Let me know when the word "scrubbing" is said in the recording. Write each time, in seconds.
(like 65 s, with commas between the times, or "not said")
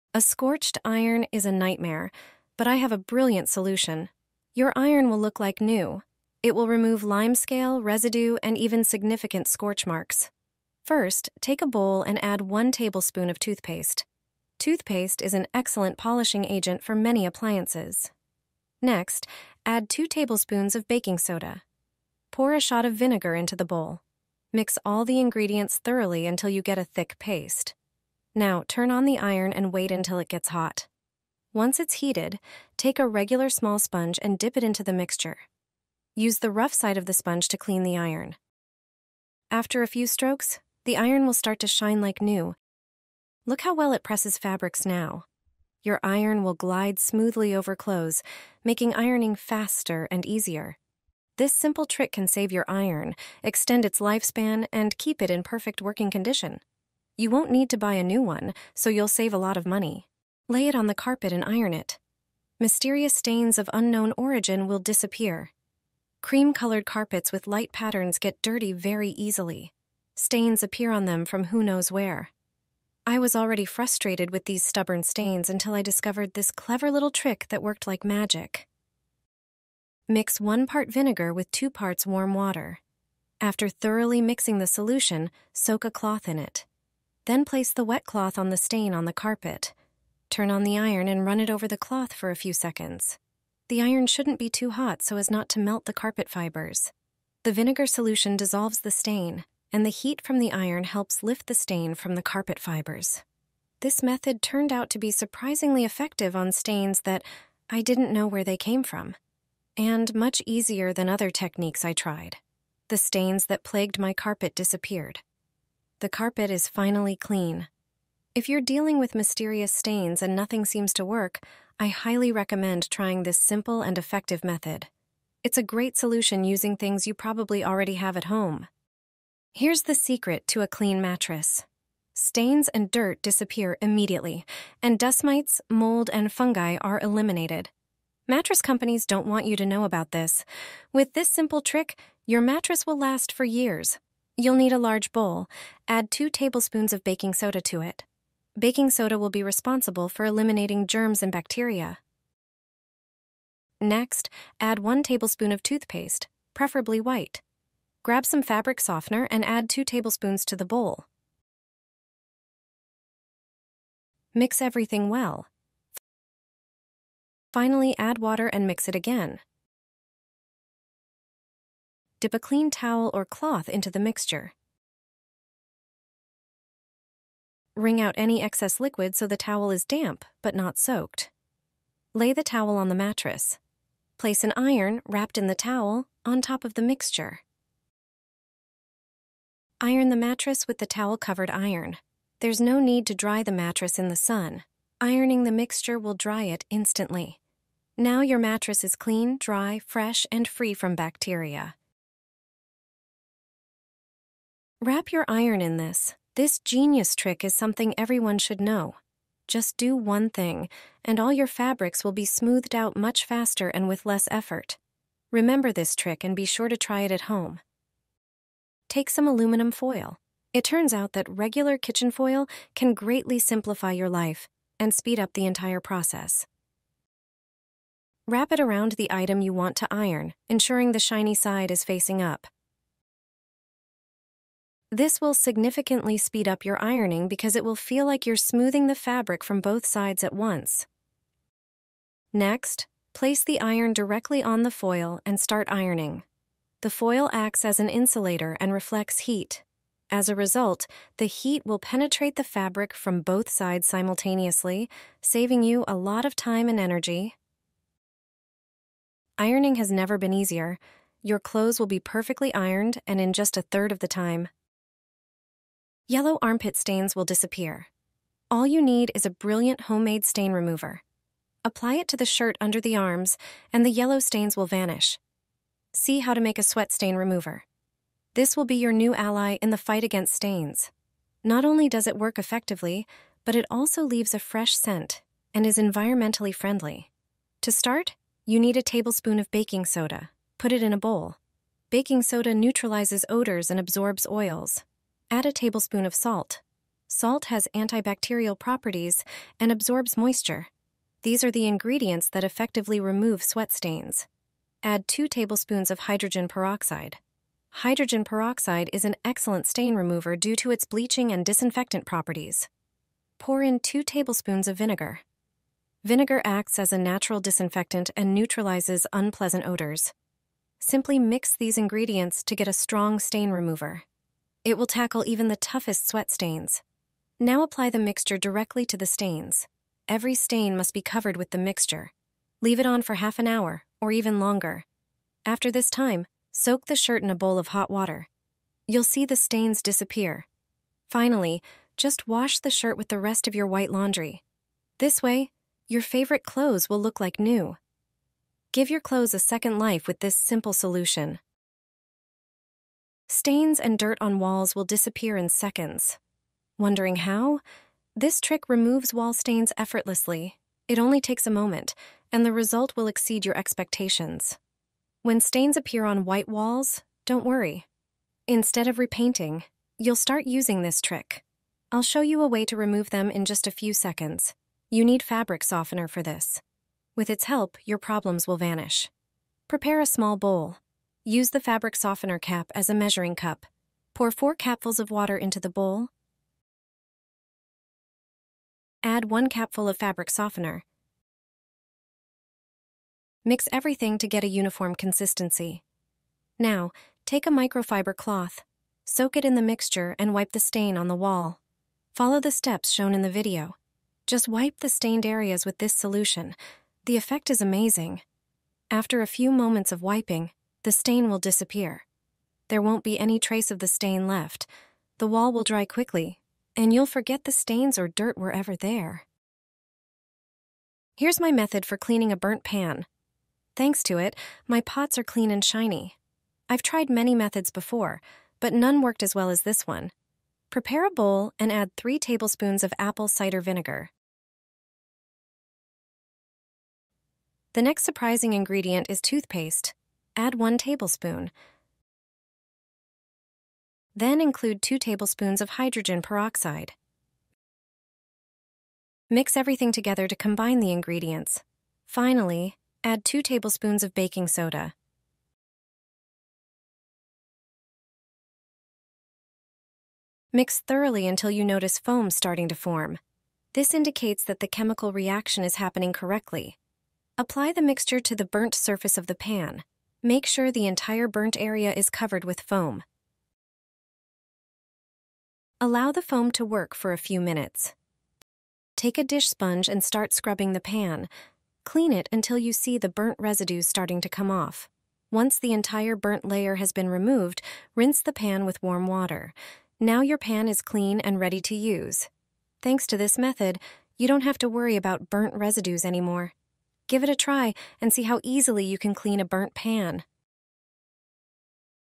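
480 s.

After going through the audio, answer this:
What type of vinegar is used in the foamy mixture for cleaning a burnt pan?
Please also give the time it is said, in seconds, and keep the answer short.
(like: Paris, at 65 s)
Apple cider vinegar, at 432 s.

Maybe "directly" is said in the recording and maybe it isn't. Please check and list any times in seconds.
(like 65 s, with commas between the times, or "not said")
243 s, 328 s.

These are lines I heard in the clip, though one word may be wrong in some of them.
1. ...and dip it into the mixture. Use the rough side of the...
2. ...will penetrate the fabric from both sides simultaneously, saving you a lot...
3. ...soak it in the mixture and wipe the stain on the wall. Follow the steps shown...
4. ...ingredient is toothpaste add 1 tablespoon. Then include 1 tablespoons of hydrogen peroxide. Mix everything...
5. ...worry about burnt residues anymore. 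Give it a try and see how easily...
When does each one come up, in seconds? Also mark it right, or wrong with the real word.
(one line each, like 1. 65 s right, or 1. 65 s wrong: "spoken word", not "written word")
1. 34 s right
2. 251 s right
3. 399 s right
4. 438 s wrong: "2", not "1"
5. 494 s right.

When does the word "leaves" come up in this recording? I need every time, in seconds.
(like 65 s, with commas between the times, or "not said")
284 s, 332 s.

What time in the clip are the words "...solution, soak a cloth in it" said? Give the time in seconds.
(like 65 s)
84 s.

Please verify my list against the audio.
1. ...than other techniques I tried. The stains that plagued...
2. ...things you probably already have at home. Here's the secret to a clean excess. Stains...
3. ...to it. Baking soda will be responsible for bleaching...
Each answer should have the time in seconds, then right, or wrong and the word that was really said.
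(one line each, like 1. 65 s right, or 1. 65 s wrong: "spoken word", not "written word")
1. 110 s right
2. 126 s wrong: "mattress", not "excess"
3. 147 s wrong: "eliminating", not "bleaching".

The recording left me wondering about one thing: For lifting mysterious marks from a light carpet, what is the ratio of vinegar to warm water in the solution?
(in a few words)
1 part vinegar to 2 parts water.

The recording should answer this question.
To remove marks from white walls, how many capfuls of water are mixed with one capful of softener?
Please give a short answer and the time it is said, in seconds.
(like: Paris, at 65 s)
4, at 384 s.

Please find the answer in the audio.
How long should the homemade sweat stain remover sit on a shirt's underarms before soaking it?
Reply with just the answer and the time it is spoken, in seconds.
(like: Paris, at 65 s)
Half an hour, at 333 s.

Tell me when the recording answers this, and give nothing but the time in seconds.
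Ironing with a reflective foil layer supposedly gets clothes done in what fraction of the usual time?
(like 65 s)
263 s.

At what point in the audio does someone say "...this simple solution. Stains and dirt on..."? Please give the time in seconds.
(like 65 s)
350 s.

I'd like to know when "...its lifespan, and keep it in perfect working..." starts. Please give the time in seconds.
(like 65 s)
53 s.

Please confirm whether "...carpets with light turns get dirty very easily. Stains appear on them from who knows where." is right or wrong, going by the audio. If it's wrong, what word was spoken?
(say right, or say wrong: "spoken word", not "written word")
wrong: "patterns", not "turns".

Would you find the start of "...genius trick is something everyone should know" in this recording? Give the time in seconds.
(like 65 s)
206 s.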